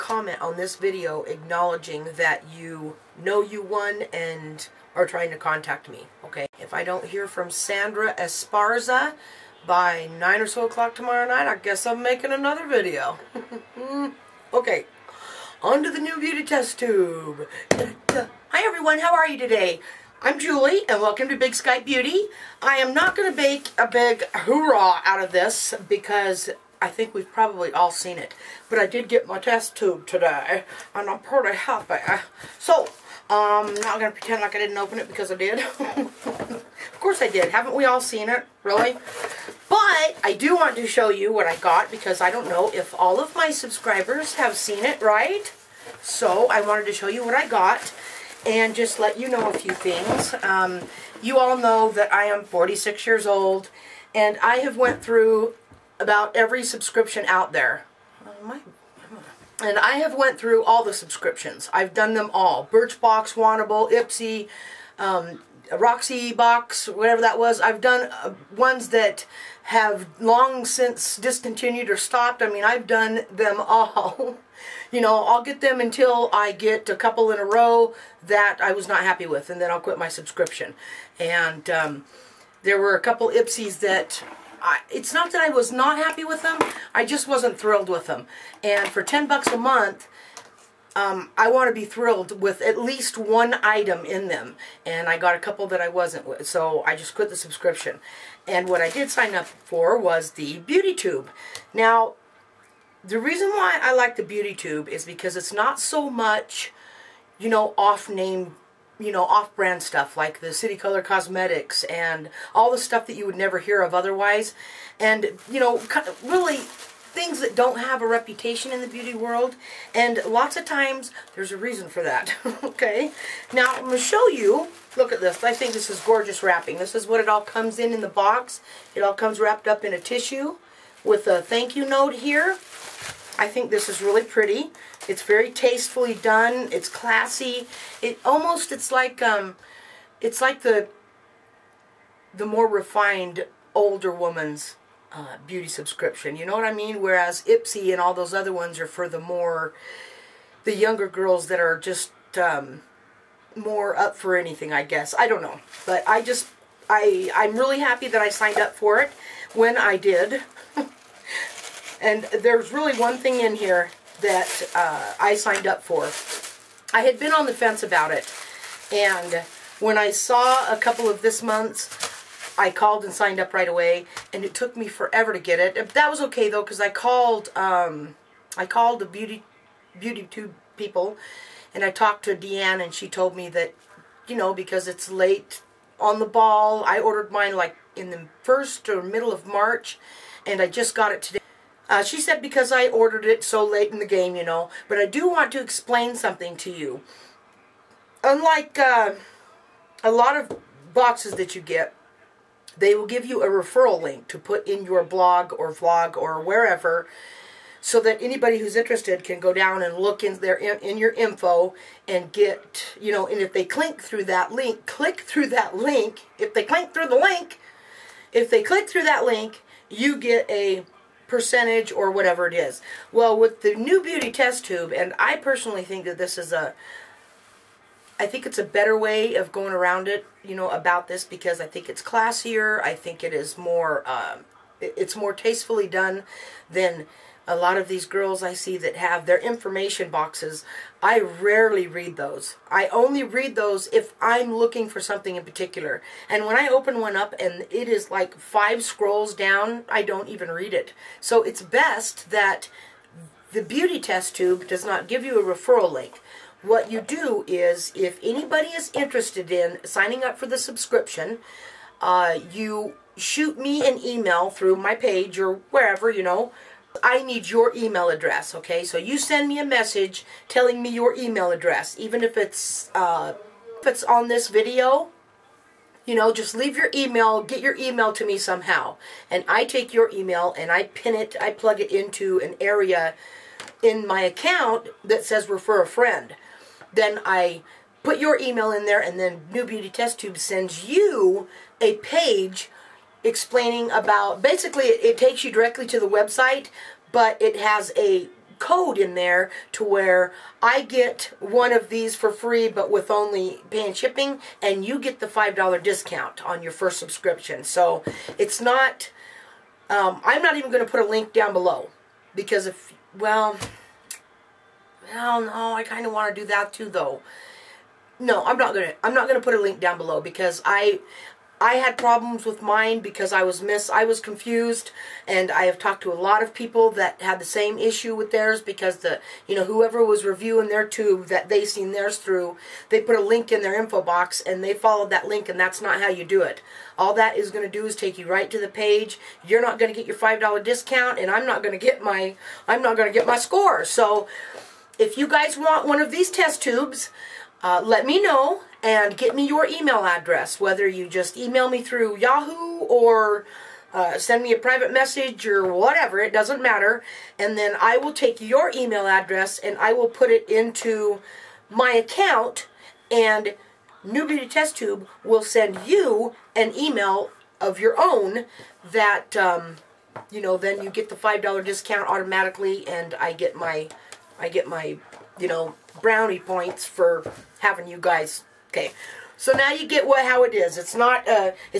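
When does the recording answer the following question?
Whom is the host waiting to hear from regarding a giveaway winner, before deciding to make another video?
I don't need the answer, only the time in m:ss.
0:07.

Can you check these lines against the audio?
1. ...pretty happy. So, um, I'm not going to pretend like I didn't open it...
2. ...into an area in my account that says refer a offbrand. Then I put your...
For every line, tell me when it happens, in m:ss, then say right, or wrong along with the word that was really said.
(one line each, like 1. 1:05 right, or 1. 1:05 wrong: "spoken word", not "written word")
1. 0:31 right
2. 4:41 wrong: "friend", not "offbrand".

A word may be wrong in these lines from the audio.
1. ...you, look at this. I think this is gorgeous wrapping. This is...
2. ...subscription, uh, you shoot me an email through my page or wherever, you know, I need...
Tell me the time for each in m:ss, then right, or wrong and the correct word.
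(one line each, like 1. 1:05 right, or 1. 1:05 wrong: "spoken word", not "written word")
1. 2:04 right
2. 4:20 right.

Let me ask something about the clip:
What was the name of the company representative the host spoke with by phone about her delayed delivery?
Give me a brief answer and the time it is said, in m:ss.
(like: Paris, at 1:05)
Deanne, at 3:02.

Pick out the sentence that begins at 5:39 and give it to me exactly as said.
You're not going to get your $5 discount and I'm not going to get my I'm not going to get my score.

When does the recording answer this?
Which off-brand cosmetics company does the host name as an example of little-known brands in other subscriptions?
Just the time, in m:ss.
1:50.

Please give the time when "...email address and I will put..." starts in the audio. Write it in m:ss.
5:58.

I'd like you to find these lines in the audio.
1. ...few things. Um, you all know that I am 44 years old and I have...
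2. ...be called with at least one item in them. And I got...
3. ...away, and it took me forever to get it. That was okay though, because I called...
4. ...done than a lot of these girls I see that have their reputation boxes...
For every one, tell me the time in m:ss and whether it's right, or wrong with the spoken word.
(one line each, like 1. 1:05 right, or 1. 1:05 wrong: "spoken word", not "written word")
1. 0:49 wrong: "46", not "44"
2. 1:31 wrong: "thrilled", not "called"
3. 2:53 right
4. 3:55 wrong: "information", not "reputation".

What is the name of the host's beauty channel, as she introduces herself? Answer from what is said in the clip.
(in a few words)
Big Sky Beauty.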